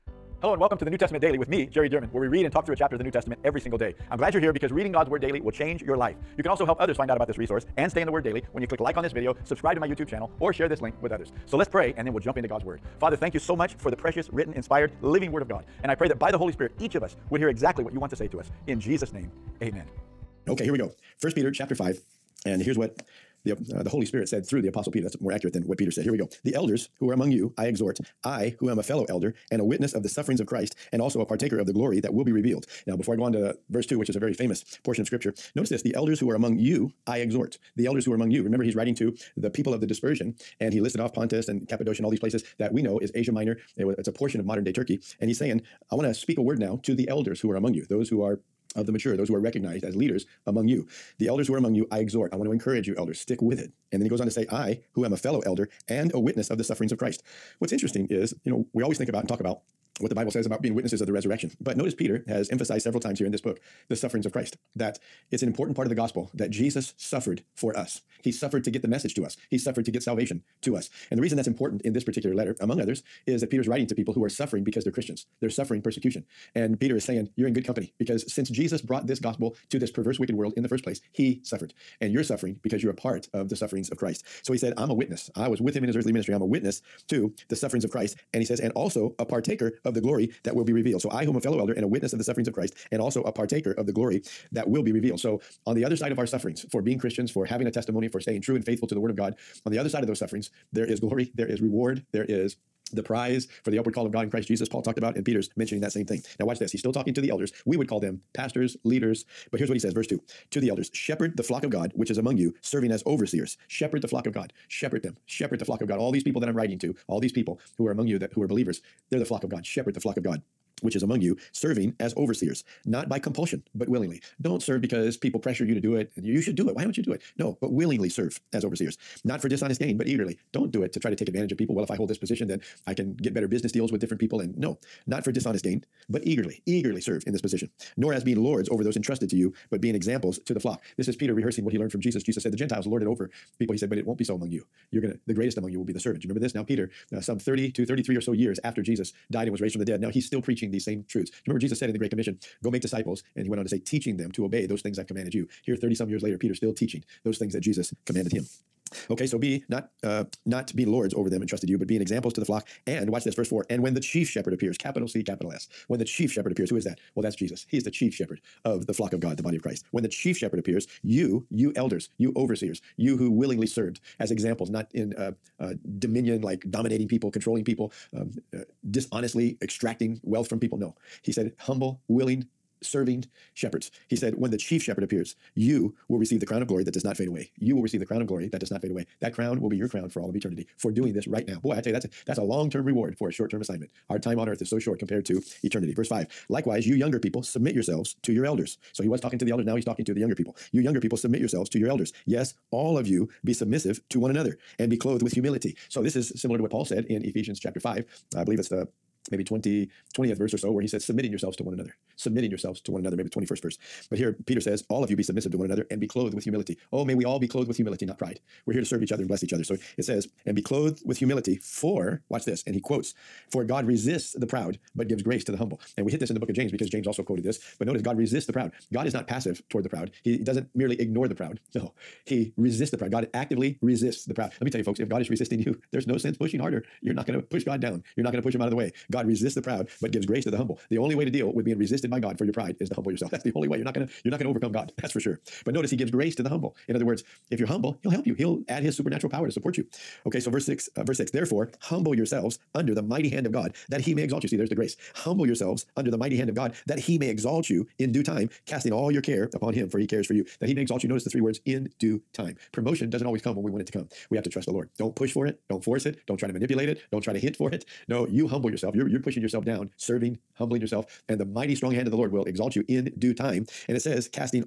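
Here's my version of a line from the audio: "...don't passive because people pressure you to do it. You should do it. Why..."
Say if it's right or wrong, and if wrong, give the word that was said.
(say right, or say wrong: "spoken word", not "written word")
wrong: "serve", not "passive".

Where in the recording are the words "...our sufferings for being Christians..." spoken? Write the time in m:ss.
1:36.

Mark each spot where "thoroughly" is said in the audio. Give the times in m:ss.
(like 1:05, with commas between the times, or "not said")
not said.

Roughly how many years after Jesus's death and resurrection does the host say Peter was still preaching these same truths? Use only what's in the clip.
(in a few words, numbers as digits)
33.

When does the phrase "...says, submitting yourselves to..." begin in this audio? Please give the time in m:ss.
3:30.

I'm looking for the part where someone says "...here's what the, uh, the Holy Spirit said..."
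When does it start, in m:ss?
0:22.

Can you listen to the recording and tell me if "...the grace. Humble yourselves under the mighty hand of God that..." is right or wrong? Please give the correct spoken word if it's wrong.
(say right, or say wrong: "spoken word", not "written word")
right.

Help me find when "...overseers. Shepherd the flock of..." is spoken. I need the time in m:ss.
1:53.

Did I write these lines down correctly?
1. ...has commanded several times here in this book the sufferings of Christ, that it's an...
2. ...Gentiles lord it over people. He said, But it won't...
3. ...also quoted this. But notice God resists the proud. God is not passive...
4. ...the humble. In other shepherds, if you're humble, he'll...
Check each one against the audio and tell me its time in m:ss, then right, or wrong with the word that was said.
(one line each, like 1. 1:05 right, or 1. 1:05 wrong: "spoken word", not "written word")
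1. 1:02 wrong: "emphasized", not "commanded"
2. 2:22 right
3. 3:47 right
4. 4:06 wrong: "words", not "shepherds".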